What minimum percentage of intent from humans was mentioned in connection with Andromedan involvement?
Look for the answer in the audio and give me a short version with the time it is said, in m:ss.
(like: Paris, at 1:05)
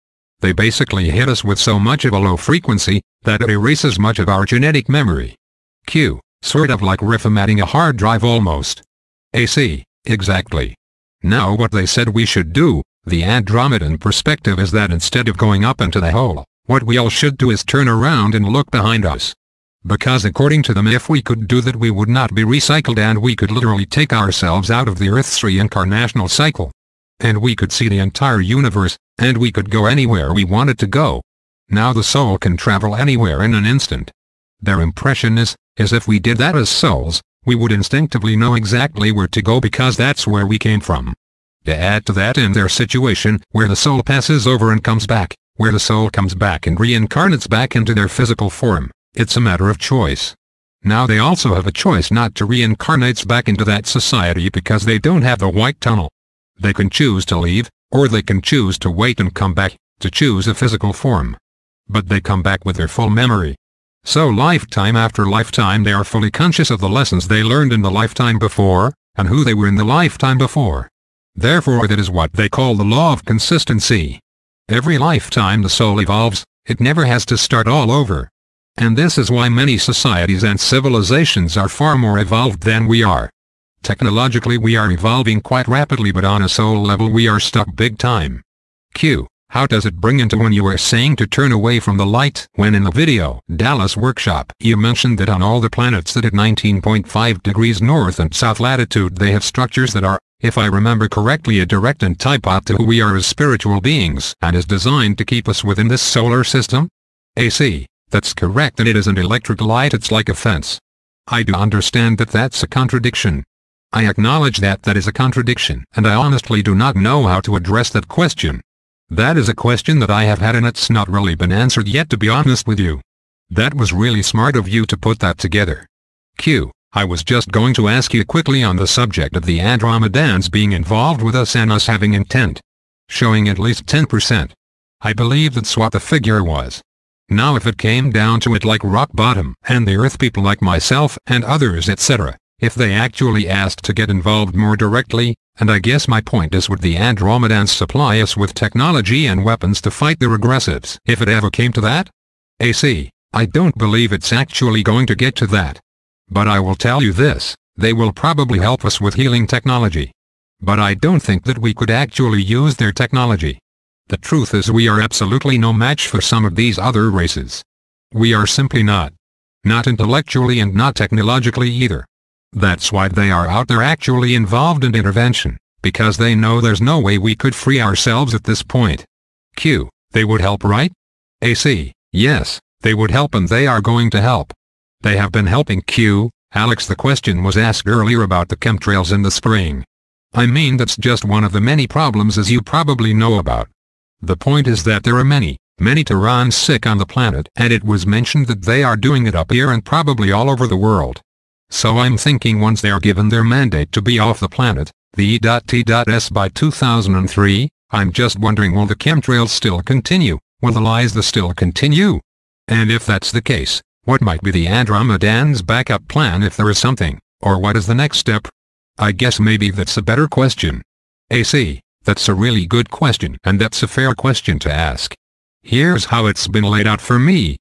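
10%, at 2:13.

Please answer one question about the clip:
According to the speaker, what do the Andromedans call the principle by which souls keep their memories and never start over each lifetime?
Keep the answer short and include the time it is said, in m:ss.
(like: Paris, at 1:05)
law of consistency, at 1:12.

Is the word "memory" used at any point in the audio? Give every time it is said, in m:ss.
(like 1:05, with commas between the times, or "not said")
0:04, 1:03.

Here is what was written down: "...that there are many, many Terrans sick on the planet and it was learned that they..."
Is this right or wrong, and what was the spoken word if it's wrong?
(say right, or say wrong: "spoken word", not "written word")
wrong: "mentioned", not "learned".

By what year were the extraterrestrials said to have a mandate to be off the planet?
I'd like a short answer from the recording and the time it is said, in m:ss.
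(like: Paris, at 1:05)
2003, at 3:26.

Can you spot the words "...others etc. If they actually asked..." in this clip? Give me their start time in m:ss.
2:21.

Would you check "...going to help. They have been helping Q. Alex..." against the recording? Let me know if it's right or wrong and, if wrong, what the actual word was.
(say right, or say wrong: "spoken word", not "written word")
right.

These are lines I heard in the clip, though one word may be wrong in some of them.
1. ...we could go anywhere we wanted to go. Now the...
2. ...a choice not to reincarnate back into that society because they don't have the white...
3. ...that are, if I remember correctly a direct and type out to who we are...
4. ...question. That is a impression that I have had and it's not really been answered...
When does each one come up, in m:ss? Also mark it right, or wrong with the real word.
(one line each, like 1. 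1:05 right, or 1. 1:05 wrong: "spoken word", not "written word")
1. 0:29 right
2. 0:51 right
3. 1:39 right
4. 1:58 wrong: "question", not "impression".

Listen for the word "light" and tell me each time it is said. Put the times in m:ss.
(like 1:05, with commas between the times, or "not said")
1:32, 1:49.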